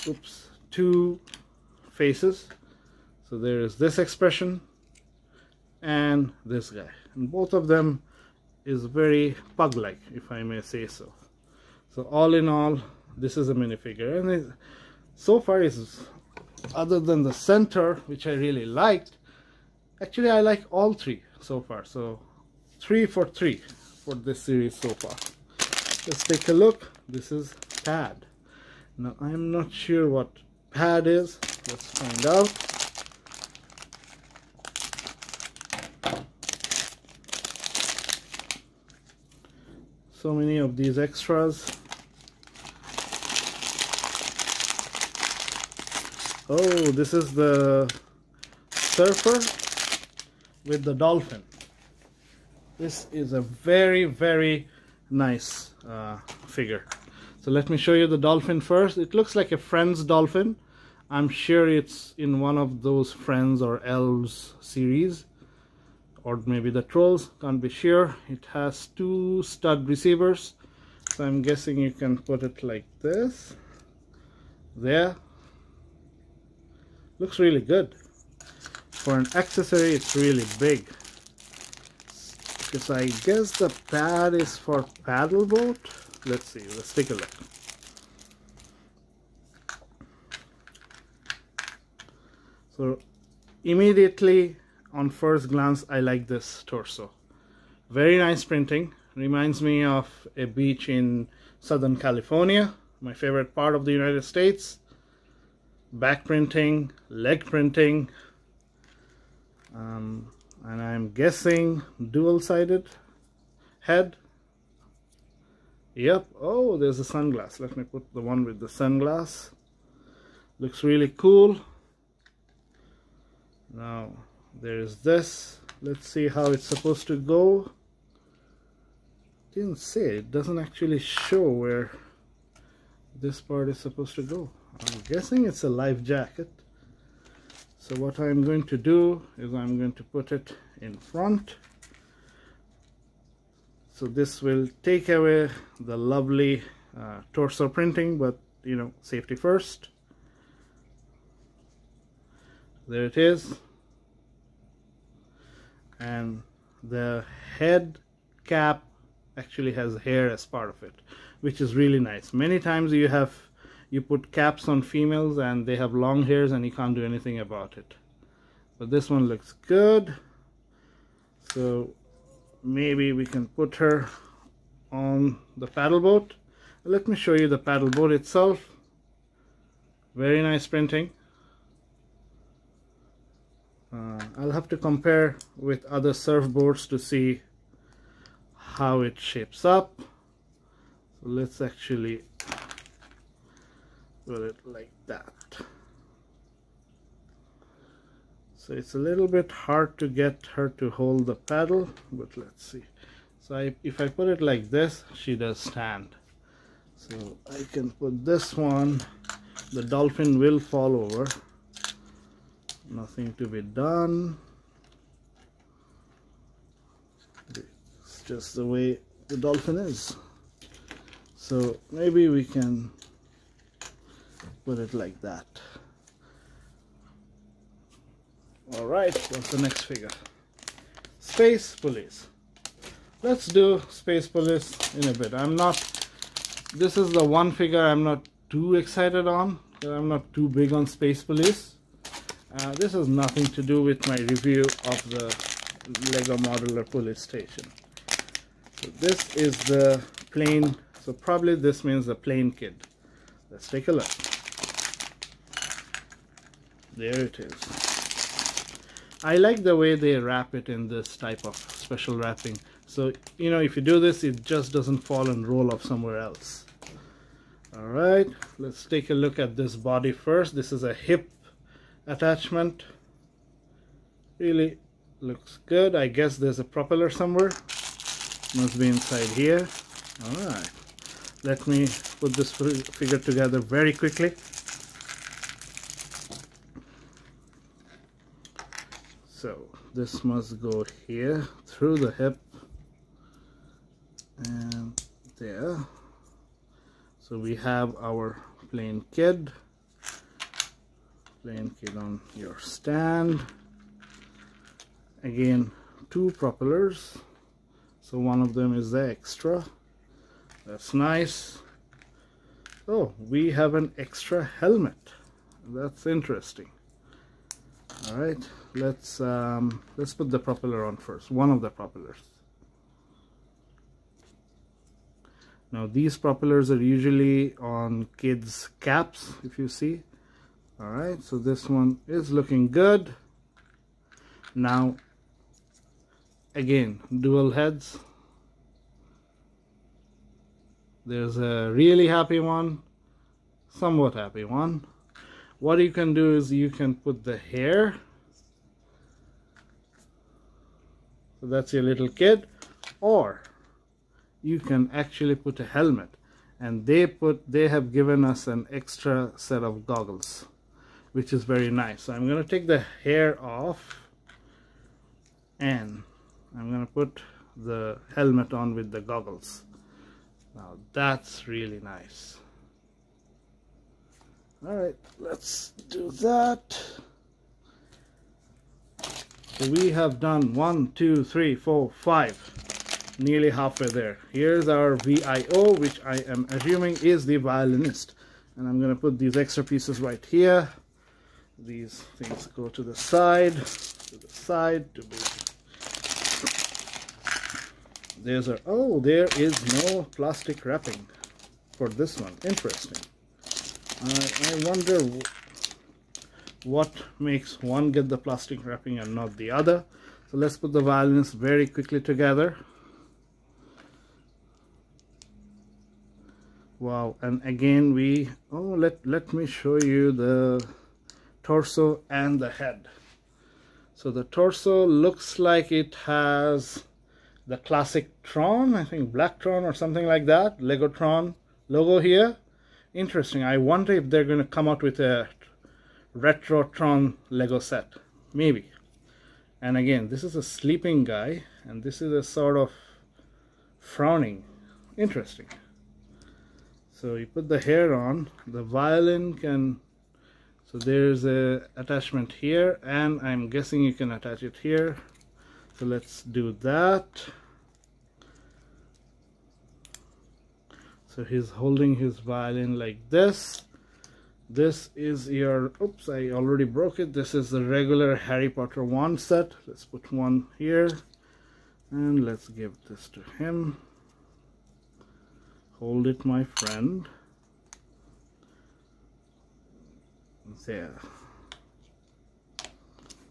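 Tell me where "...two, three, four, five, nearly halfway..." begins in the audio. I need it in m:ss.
6:20.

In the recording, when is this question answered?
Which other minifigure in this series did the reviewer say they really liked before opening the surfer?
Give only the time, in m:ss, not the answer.
0:17.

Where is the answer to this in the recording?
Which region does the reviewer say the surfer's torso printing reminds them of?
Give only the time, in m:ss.
1:41.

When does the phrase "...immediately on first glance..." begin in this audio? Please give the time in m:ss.
1:33.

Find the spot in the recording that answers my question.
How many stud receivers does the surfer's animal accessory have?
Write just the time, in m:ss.
1:08.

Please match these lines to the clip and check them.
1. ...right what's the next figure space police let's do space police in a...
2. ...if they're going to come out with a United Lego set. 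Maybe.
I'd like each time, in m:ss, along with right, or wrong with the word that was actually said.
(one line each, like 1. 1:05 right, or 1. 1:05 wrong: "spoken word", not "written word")
1. 3:48 right
2. 7:13 wrong: "Retrotron", not "United".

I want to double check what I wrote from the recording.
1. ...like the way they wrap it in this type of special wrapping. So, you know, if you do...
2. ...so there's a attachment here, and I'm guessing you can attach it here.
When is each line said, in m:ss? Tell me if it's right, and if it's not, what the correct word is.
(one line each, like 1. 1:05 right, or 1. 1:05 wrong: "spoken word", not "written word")
1. 4:19 right
2. 7:30 right.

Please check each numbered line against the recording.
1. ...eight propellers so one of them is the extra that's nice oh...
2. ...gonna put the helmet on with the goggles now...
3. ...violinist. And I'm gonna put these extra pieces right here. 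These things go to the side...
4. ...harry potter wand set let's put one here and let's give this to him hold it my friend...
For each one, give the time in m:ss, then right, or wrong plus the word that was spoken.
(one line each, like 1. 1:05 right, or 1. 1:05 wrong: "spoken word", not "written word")
1. 5:06 wrong: "two", not "eight"
2. 6:06 right
3. 6:27 right
4. 7:48 right.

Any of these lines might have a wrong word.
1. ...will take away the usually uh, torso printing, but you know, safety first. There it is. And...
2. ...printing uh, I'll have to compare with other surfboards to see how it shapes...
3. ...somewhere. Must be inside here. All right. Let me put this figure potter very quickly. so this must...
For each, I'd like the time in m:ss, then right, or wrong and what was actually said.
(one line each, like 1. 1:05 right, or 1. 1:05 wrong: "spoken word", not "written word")
1. 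2:24 wrong: "lovely", not "usually"
2. 3:00 right
3. 4:37 wrong: "together", not "potter".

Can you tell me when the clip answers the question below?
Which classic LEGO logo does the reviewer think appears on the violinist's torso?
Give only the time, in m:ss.
7:09.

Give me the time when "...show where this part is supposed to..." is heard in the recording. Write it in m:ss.
2:10.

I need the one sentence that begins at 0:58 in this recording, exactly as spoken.
It looks like a Friends dolphin.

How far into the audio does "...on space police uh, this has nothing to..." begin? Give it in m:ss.
4:00.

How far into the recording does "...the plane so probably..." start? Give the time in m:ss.
4:09.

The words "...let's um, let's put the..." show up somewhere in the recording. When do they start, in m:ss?
5:18.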